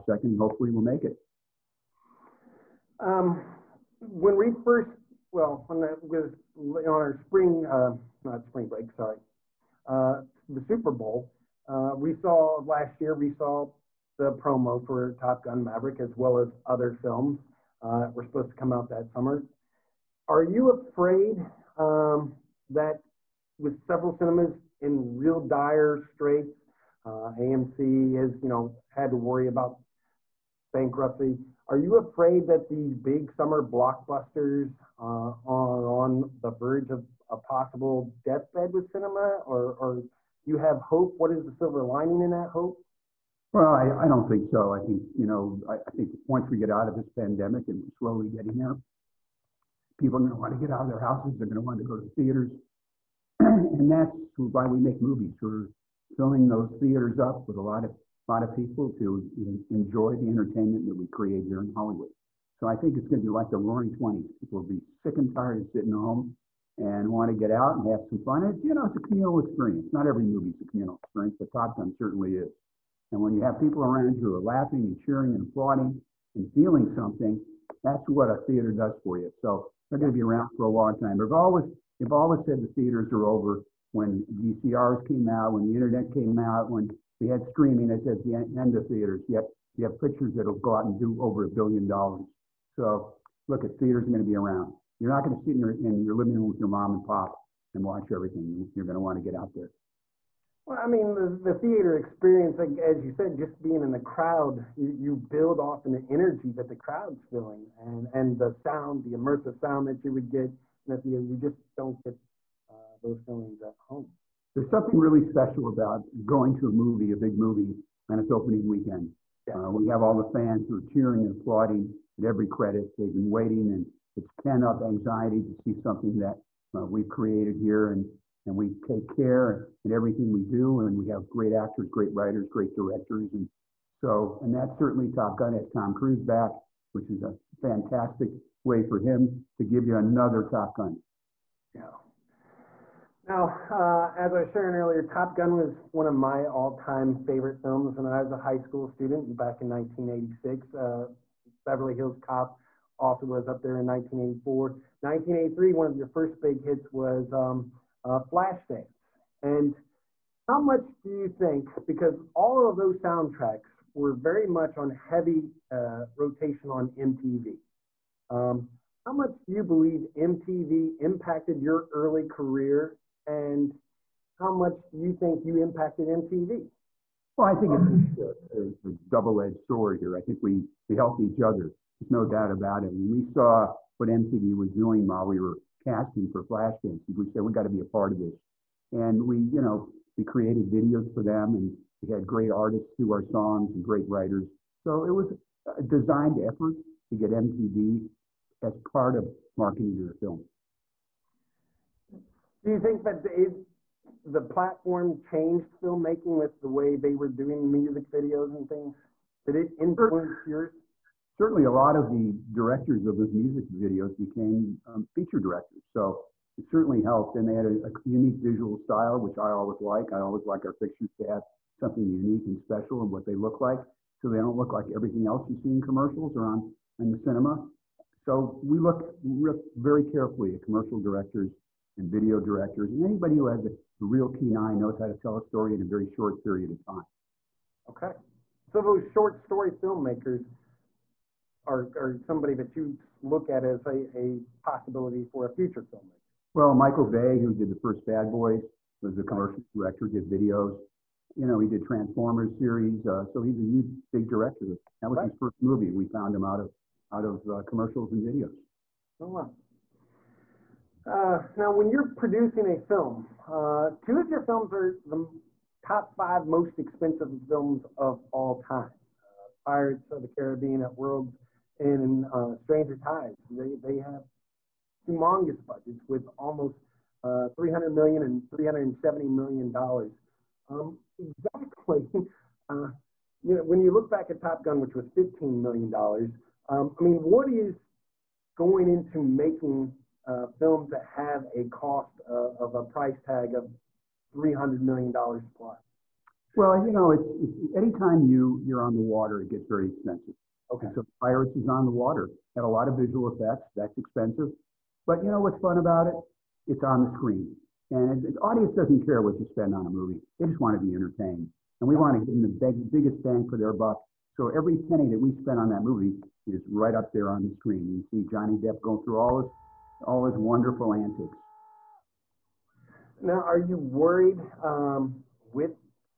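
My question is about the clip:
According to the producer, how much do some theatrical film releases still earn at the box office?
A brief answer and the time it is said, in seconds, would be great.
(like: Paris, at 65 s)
over a billion dollars, at 91 s.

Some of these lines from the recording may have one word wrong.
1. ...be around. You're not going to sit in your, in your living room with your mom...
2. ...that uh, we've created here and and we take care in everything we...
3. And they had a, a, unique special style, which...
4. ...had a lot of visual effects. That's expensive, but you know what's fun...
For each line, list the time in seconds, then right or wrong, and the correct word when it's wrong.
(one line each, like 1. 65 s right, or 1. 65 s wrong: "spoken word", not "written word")
1. 94 s right
2. 126 s right
3. 217 s wrong: "visual", not "special"
4. 302 s right.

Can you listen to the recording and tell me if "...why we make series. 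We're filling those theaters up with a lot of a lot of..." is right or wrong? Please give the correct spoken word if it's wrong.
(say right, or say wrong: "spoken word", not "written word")
wrong: "movies", not "series".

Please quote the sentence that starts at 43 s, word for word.
Well, I, I don't think so.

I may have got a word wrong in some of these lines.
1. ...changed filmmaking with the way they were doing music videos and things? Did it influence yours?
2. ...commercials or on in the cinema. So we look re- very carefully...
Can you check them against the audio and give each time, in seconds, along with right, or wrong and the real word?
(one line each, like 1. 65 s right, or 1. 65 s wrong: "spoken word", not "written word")
1. 205 s right
2. 225 s right.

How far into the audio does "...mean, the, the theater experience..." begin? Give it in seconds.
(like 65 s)
100 s.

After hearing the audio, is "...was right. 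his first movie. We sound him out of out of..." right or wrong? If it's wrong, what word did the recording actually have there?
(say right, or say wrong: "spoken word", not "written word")
wrong: "found", not "sound".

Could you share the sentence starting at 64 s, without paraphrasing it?
People will be sick and tired of sitting home and want to get out and have some fun.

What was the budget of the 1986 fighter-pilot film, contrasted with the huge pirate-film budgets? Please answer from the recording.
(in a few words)
15 million dollars.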